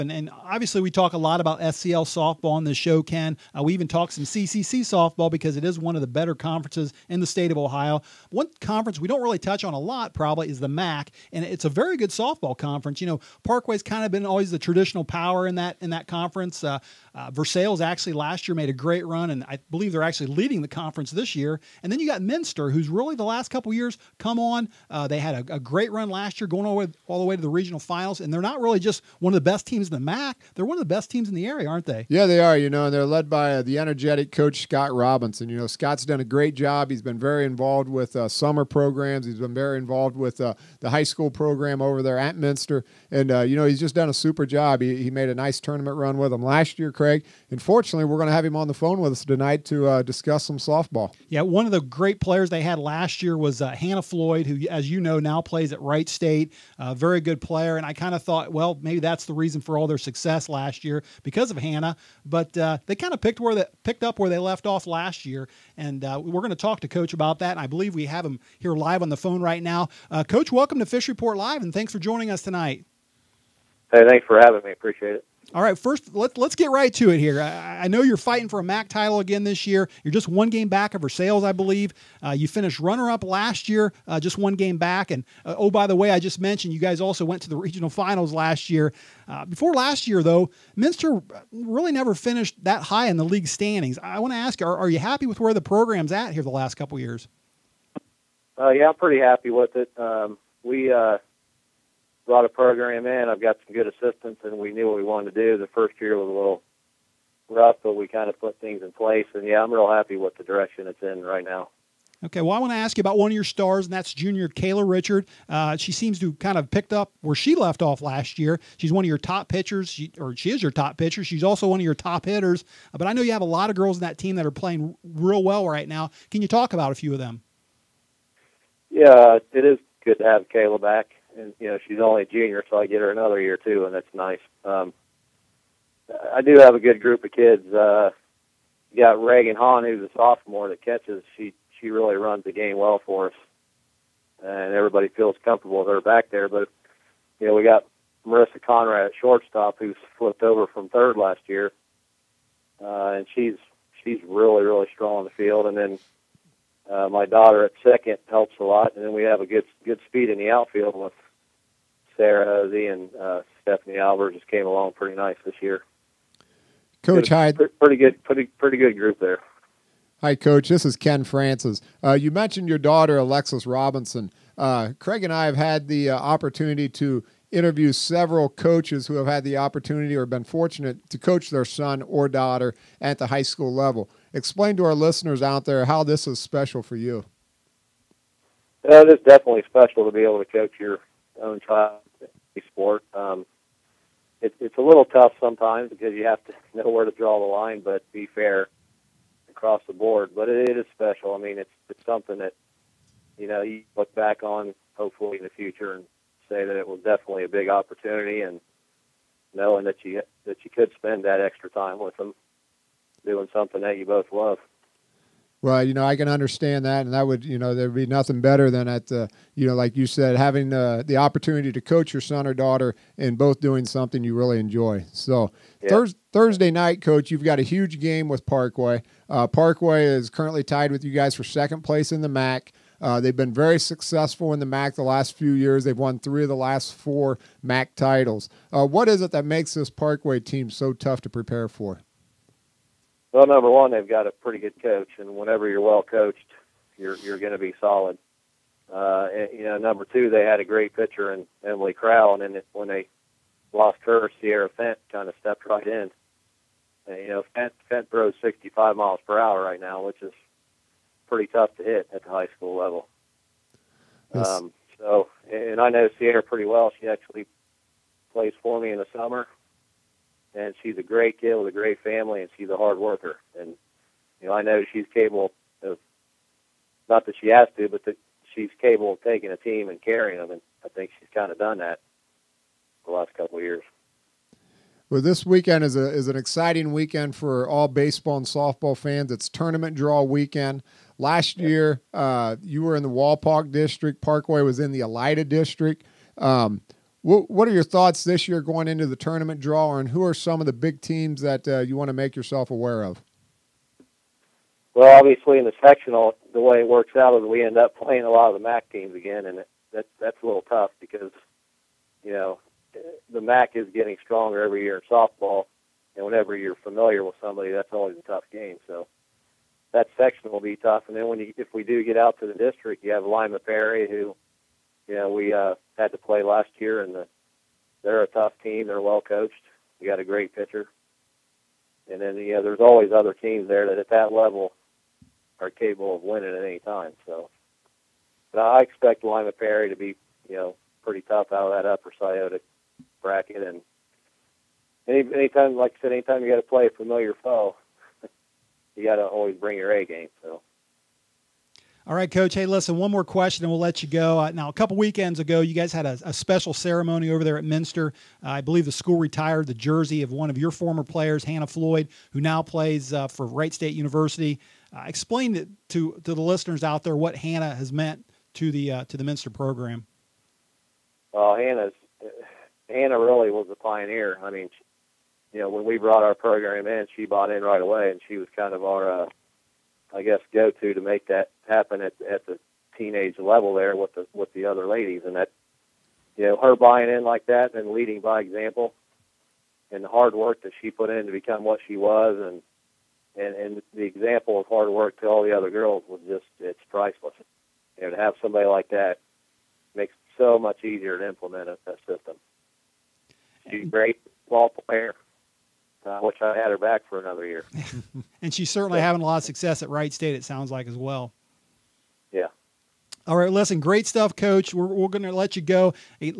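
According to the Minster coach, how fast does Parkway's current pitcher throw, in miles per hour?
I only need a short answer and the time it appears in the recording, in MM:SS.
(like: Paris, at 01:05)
65, at 04:18.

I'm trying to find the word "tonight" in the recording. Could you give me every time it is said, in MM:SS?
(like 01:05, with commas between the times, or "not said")
00:49, 01:12.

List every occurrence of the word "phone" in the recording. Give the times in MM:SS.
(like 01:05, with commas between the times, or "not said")
00:48, 01:09.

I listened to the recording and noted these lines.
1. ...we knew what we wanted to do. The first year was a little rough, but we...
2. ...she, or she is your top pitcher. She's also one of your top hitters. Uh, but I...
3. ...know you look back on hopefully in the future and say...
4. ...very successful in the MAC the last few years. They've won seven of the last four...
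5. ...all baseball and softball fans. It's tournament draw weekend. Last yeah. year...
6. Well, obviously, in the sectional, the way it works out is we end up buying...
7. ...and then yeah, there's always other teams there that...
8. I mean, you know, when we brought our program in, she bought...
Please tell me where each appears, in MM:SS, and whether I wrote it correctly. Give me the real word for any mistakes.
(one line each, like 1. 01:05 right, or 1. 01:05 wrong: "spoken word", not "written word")
1. 01:44 right
2. 01:59 right
3. 03:23 right
4. 03:53 wrong: "three", not "seven"
5. 04:47 right
6. 05:04 wrong: "playing", not "buying"
7. 05:32 right
8. 06:14 right.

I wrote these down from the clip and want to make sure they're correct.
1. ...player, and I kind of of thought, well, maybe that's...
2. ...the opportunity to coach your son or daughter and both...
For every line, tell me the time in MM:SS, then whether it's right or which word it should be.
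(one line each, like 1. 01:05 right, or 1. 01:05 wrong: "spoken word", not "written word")
1. 00:57 right
2. 03:41 right.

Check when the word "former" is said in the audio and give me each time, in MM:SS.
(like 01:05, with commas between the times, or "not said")
06:00.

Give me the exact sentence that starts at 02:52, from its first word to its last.
Uh, you mentioned your daughter, Alexis Robinson.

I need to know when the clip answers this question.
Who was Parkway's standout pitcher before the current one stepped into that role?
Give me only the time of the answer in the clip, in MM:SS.
04:11.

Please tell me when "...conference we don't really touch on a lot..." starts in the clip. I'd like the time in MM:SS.
00:08.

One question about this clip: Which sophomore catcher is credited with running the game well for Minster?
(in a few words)
Reagan Hahn.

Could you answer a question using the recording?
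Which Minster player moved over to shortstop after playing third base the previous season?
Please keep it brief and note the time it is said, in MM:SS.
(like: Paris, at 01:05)
Marissa Conrad, at 02:28.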